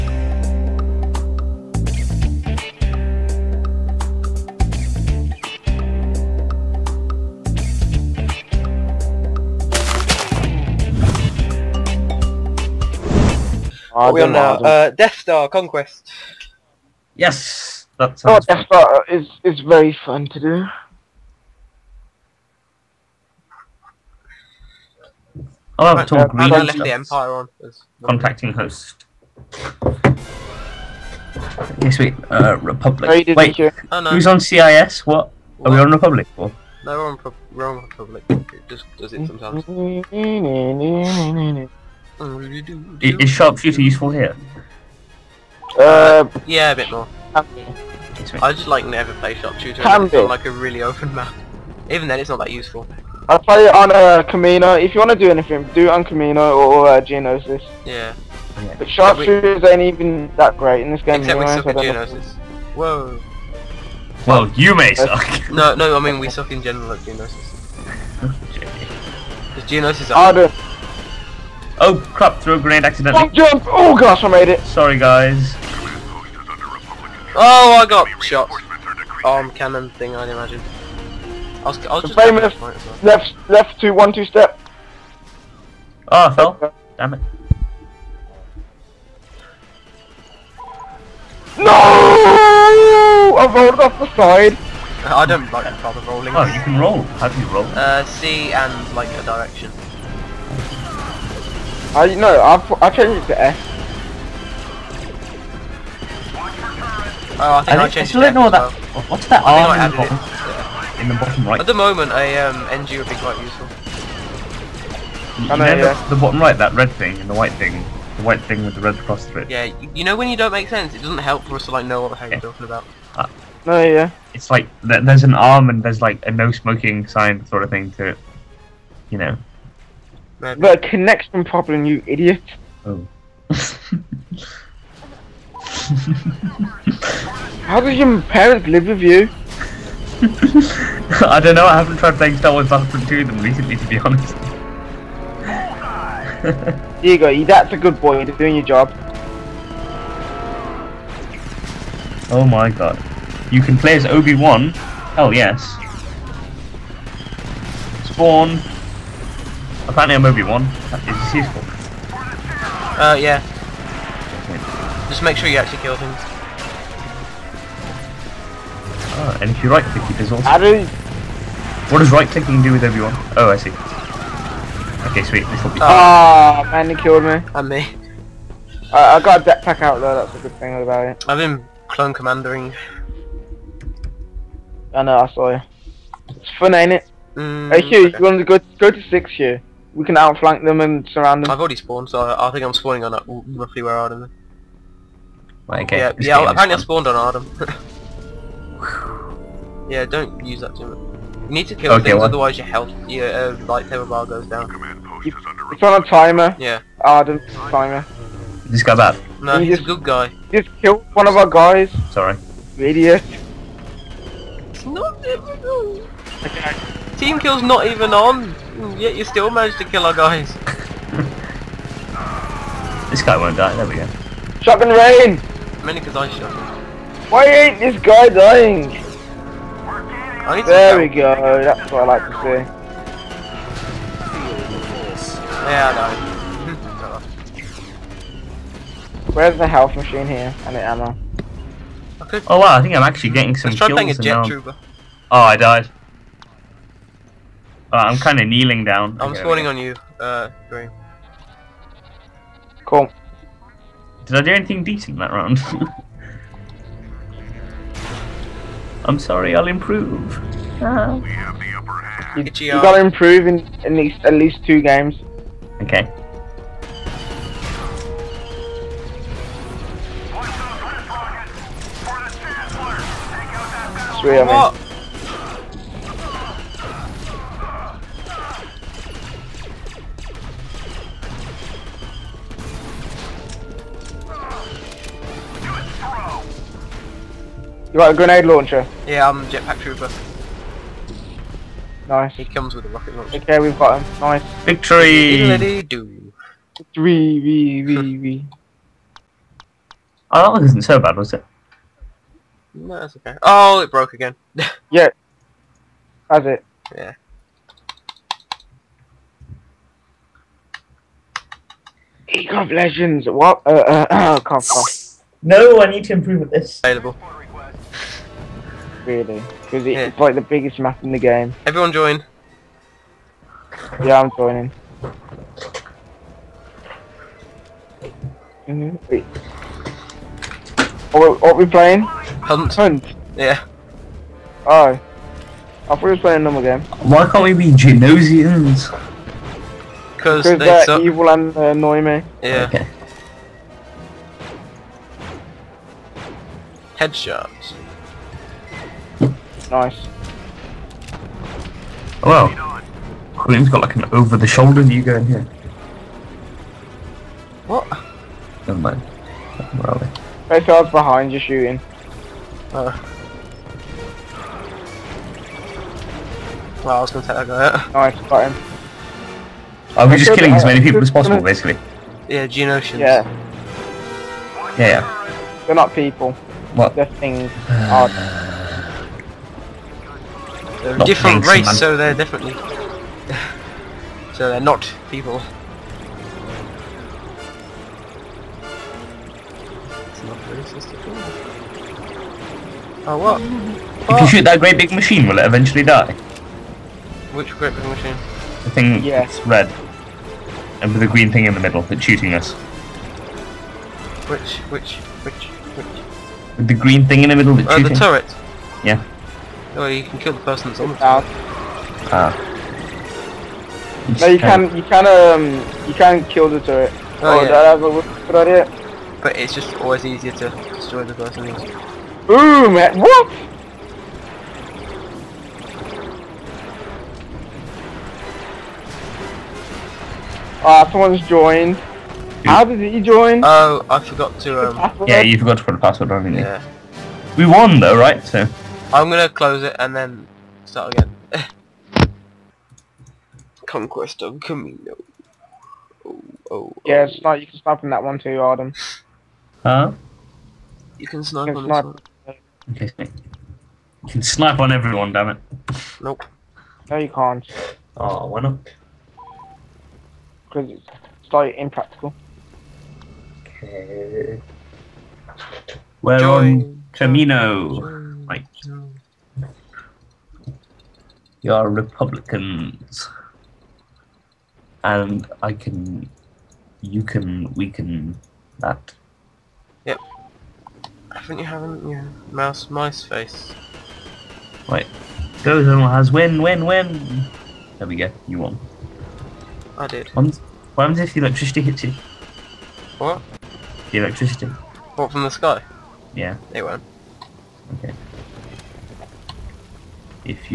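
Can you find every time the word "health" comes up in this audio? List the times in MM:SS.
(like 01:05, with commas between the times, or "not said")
03:22, 03:59.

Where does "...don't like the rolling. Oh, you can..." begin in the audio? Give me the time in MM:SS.
01:35.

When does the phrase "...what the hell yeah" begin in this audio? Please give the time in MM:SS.
02:01.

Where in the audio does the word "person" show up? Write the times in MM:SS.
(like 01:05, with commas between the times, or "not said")
06:50, 07:01.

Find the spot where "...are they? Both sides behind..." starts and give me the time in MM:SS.
05:59.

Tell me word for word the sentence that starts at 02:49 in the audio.
Oh, and if you right click, it does also.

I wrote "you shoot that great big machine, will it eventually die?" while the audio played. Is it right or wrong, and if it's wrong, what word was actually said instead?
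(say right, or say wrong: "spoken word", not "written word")
right.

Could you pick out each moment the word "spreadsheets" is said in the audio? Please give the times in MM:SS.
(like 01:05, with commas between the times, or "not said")
not said.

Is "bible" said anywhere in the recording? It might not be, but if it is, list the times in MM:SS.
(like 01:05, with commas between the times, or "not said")
not said.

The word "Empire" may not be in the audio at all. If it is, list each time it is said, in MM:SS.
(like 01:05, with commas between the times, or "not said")
00:26.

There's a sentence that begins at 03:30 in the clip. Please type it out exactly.
Just killed one of our guys.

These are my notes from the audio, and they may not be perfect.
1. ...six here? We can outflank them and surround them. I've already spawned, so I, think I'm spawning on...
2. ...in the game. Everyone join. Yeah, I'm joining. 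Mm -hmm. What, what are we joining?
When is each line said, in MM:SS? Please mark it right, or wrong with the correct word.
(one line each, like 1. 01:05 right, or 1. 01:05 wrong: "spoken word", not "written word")
1. 03:09 right
2. 05:21 wrong: "playing", not "joining".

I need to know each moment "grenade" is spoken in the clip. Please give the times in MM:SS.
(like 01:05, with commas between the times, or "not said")
01:12, 04:48.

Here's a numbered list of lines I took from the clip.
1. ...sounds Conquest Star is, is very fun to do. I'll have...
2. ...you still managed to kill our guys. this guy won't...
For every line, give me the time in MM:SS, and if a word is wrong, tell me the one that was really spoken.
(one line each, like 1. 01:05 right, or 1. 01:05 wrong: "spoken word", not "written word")
1. 00:18 wrong: "Death", not "Conquest"
2. 03:39 right.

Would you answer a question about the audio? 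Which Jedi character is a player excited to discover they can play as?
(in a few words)
Obi-Wan.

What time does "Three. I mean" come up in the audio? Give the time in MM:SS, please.
04:34.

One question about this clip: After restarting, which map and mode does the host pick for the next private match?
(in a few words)
Conquest of Kamino.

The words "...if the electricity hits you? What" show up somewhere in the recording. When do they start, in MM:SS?
08:10.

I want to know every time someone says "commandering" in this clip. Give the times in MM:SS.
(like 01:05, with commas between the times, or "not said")
03:02.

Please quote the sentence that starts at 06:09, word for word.
Are we just killing as many people as possible, basically?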